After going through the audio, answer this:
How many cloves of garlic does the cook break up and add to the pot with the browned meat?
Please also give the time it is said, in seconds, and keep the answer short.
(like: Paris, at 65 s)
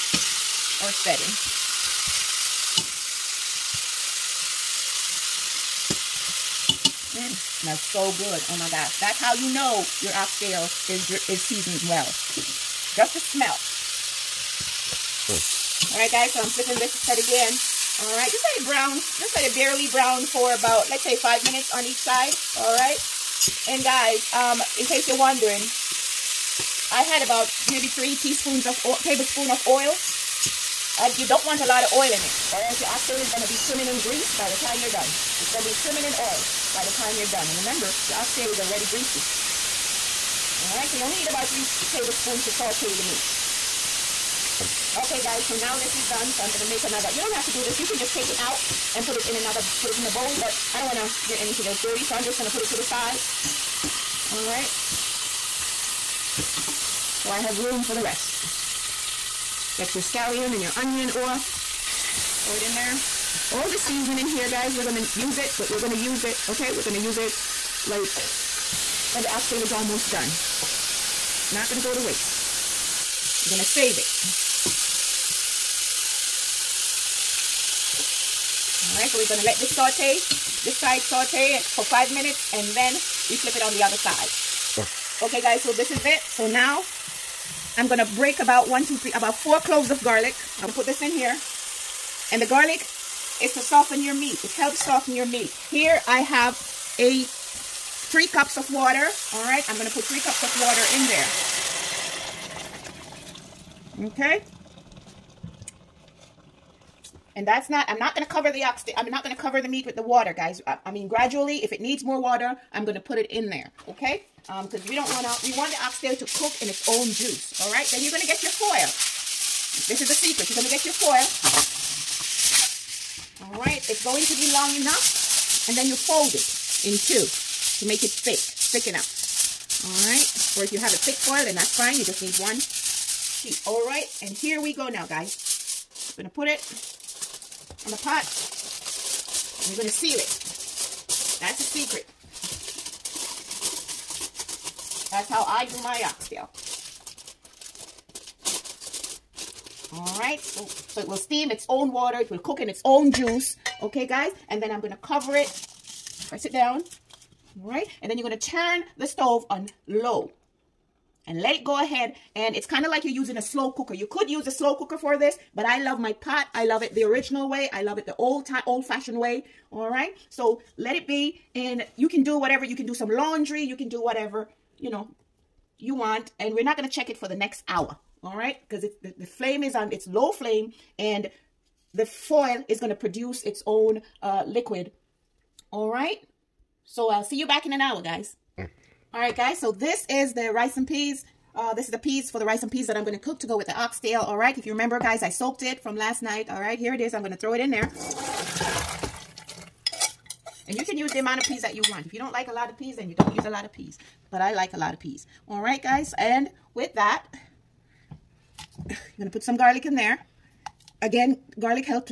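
4, at 89 s.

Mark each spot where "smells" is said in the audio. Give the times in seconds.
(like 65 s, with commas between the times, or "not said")
7 s, 13 s.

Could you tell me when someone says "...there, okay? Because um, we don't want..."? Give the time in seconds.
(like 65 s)
113 s.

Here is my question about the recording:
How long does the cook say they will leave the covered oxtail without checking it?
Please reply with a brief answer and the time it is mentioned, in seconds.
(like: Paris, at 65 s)
an hour, at 177 s.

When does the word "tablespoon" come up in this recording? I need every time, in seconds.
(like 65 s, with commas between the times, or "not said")
29 s, 41 s.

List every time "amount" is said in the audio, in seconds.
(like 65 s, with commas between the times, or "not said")
201 s.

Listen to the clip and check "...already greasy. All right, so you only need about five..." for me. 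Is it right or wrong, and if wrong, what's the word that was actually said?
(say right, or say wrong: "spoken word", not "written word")
wrong: "three", not "five".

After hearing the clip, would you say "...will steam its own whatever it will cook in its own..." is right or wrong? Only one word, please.
wrong.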